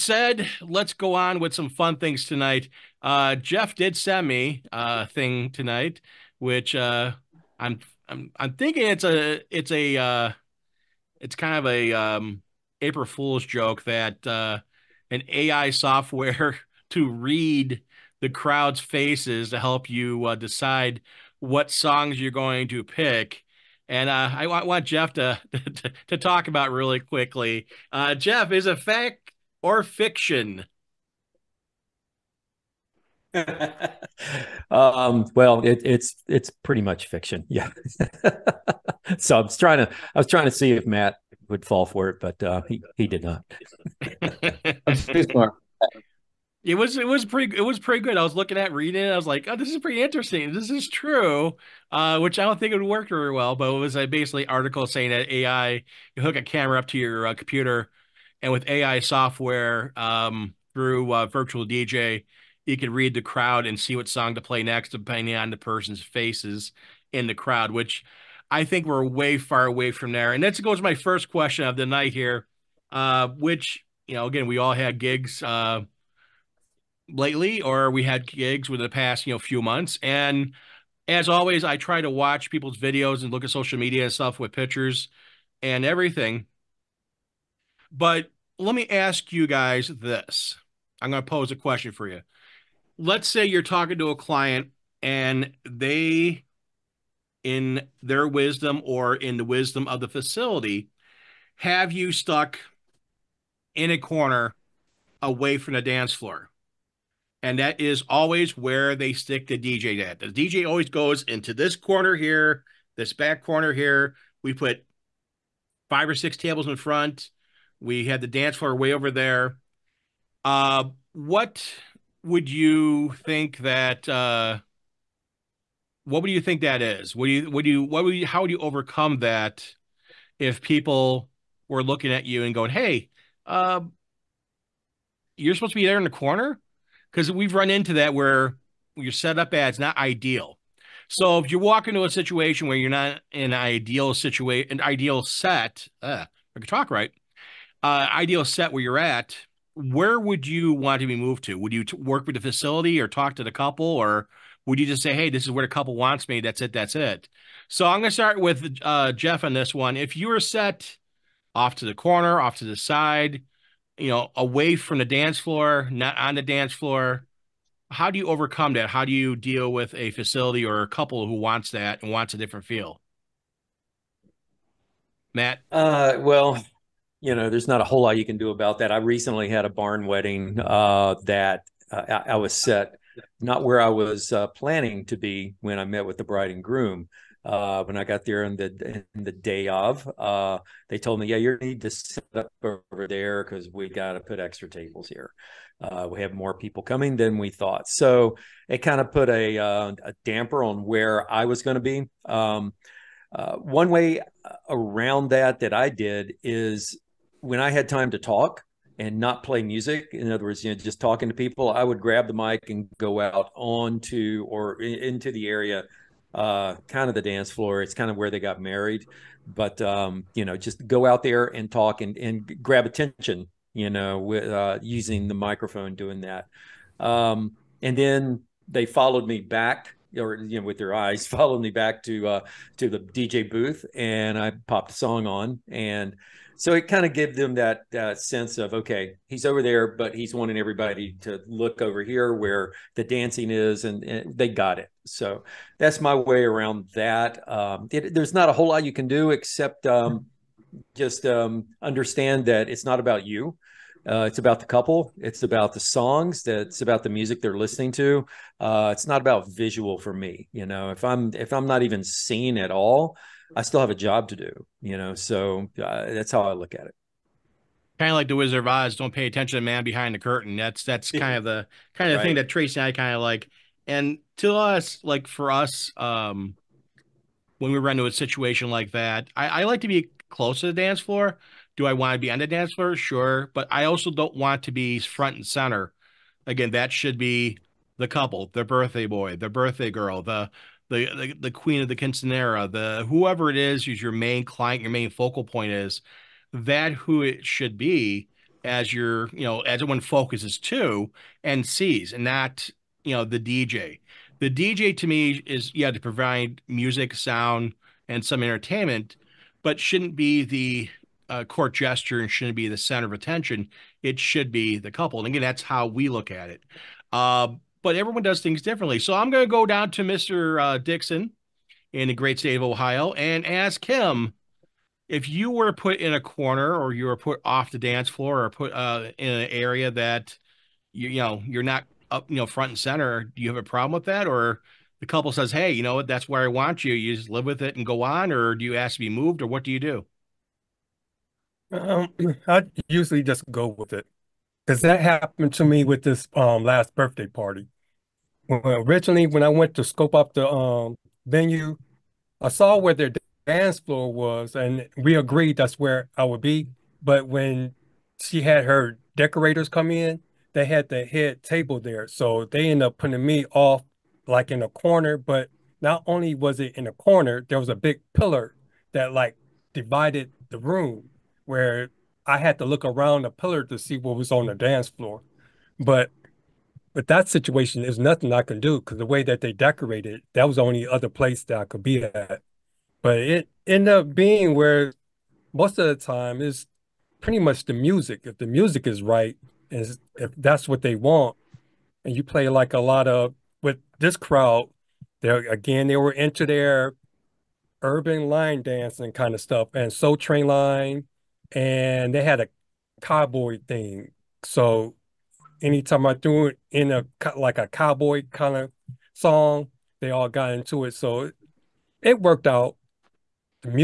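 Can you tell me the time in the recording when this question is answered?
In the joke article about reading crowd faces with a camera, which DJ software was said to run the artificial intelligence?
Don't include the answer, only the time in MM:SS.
01:01.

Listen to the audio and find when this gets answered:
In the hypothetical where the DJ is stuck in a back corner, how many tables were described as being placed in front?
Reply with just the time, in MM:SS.
01:55.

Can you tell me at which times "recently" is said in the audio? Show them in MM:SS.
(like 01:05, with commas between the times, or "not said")
02:58.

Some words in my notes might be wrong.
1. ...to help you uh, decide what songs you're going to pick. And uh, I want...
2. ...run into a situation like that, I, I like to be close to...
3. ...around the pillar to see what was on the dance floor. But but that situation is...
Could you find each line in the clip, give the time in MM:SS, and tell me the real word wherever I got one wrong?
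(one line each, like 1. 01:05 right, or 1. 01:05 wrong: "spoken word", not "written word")
1. 00:19 right
2. 04:37 right
3. 06:12 right.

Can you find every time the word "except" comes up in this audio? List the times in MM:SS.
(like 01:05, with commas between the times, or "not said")
04:09.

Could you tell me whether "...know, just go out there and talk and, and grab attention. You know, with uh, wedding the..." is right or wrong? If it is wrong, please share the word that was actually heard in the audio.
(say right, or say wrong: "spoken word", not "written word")
wrong: "using", not "wedding".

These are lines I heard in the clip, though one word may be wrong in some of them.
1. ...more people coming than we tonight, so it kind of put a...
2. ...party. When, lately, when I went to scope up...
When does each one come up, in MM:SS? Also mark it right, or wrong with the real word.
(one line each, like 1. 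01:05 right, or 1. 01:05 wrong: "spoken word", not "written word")
1. 03:16 wrong: "thought", not "tonight"
2. 05:47 wrong: "originally", not "lately".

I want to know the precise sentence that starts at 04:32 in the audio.
thing that Tracy and I kind of like.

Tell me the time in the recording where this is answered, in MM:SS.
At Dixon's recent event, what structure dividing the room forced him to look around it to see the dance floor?
06:07.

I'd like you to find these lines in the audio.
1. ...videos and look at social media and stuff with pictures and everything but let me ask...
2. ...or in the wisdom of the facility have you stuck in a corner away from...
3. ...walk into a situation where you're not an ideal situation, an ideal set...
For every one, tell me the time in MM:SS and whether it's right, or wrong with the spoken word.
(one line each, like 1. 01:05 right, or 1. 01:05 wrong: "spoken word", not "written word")
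1. 01:22 right
2. 01:38 right
3. 02:21 right.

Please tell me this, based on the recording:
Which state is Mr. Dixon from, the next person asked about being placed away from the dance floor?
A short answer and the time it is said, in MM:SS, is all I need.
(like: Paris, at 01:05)
Ohio, at 05:22.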